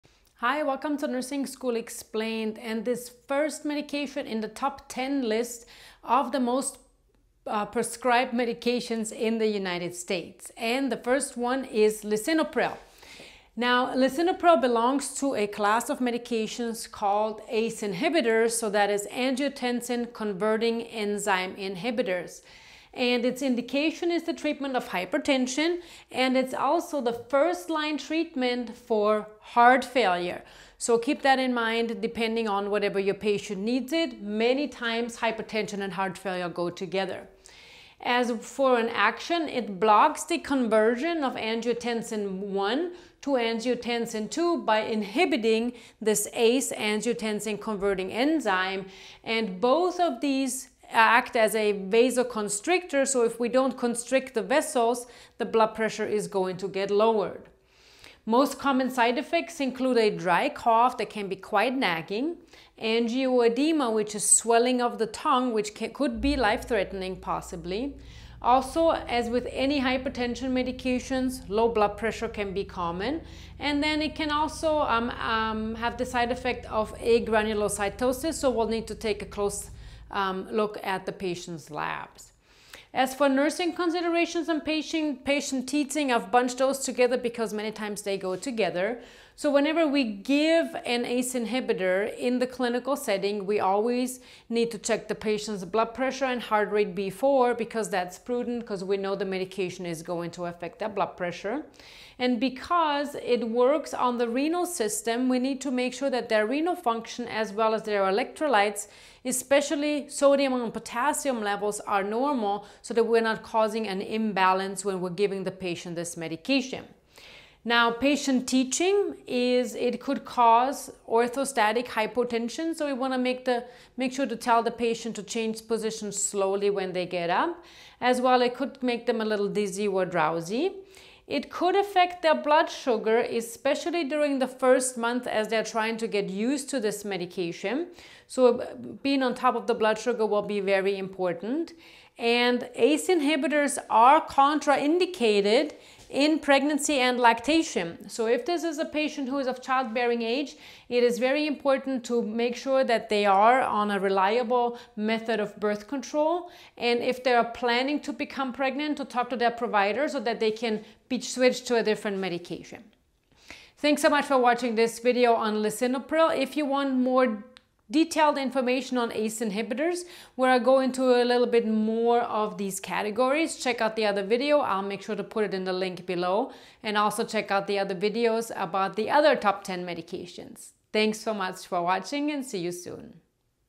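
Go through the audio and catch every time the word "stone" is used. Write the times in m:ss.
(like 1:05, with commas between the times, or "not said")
not said.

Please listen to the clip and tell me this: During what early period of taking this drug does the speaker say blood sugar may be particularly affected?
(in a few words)
The first month.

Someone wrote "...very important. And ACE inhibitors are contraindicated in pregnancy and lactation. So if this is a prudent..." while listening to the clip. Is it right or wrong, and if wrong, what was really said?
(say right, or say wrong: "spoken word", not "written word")
wrong: "patient", not "prudent".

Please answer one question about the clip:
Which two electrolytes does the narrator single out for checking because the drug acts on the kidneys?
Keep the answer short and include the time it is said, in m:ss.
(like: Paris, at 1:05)
Sodium and potassium, at 1:50.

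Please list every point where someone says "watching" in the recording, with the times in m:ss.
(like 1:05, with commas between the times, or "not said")
2:44, 3:01.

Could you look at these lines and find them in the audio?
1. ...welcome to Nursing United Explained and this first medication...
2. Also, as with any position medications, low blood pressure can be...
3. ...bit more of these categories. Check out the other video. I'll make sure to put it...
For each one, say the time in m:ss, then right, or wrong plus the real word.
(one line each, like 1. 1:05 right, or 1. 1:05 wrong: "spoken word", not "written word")
1. 0:00 wrong: "School", not "United"
2. 1:08 wrong: "hypertension", not "position"
3. 2:51 right.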